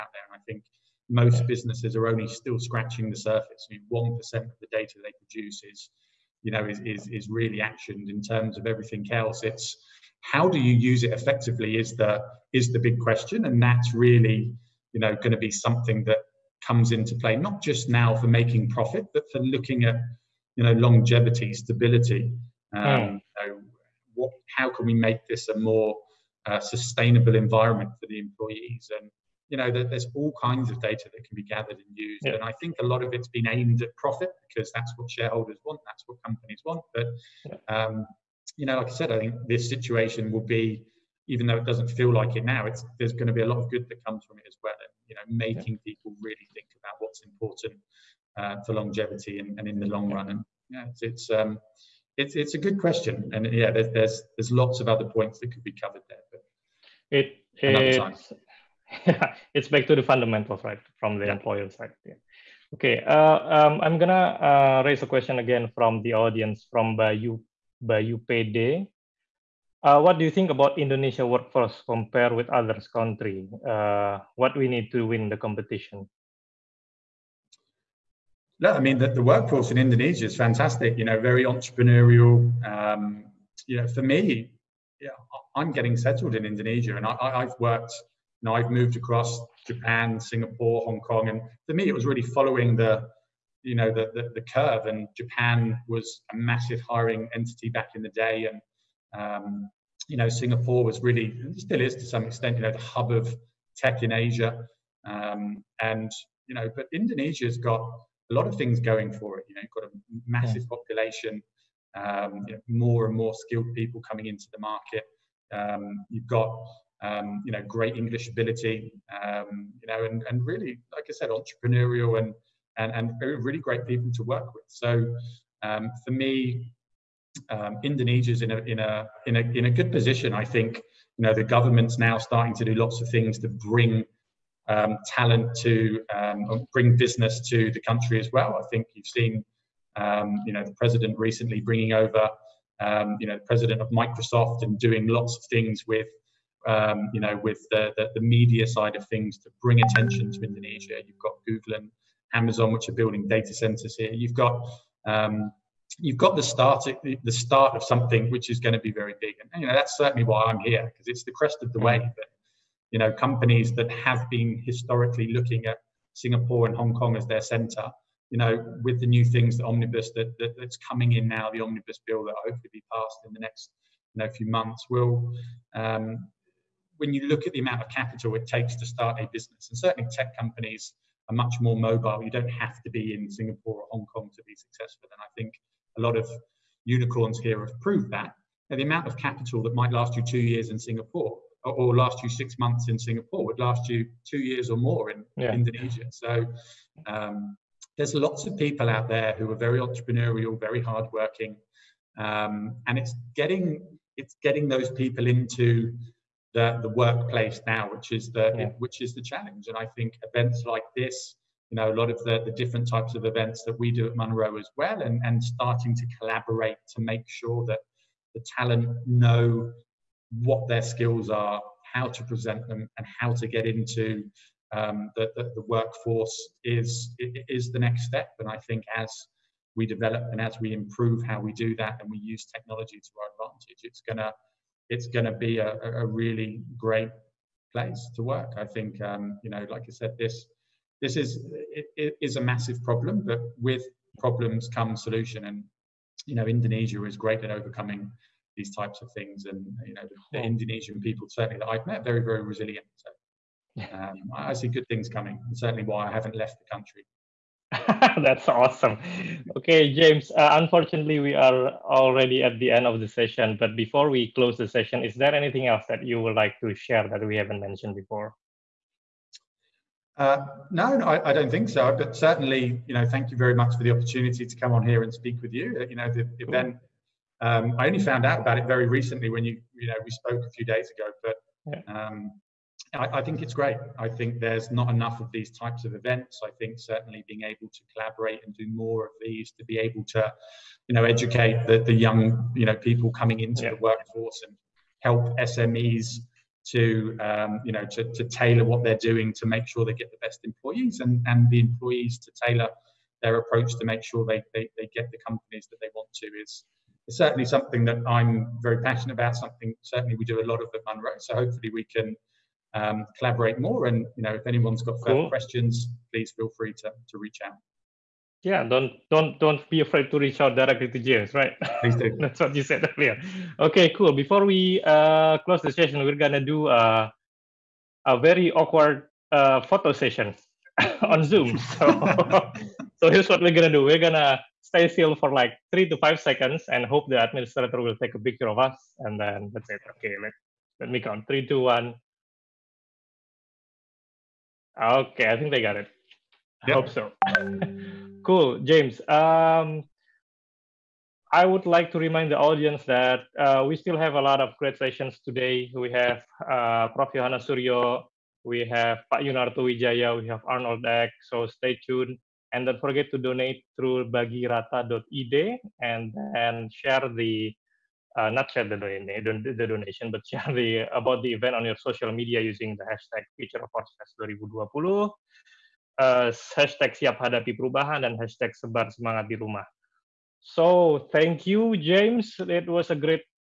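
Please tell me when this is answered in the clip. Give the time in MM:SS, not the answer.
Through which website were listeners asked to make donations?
06:04.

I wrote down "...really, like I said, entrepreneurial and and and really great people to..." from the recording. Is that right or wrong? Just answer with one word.
right.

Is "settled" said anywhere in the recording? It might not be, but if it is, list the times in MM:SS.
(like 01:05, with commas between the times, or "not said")
01:25.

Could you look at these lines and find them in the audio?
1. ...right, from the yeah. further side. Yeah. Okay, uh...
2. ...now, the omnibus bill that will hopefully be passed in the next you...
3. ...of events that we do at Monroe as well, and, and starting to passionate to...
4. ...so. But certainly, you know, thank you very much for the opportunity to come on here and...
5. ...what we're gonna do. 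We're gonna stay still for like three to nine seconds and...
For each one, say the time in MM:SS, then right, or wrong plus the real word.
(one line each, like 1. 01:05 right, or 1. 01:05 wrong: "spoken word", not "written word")
1. 01:00 wrong: "employer", not "further"
2. 02:51 right
3. 03:33 wrong: "collaborate", not "passionate"
4. 04:31 right
5. 05:33 wrong: "five", not "nine".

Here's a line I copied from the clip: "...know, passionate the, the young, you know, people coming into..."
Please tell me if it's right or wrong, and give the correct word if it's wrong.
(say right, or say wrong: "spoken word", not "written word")
wrong: "educate", not "passionate".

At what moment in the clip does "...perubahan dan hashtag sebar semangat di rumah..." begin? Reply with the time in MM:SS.
06:17.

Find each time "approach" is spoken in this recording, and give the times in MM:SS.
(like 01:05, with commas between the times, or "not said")
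05:03.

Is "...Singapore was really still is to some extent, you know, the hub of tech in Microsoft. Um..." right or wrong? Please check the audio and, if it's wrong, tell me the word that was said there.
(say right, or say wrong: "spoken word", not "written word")
wrong: "Asia", not "Microsoft".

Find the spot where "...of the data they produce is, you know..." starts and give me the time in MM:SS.
00:04.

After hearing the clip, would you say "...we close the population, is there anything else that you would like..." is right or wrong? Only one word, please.
wrong.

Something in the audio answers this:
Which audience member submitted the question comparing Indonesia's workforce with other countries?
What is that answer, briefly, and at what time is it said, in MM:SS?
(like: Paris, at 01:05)
Bayu PD, at 01:06.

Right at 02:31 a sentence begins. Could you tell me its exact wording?
You've got Google and Amazon, which are building data centers here.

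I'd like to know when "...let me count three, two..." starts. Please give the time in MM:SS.
05:40.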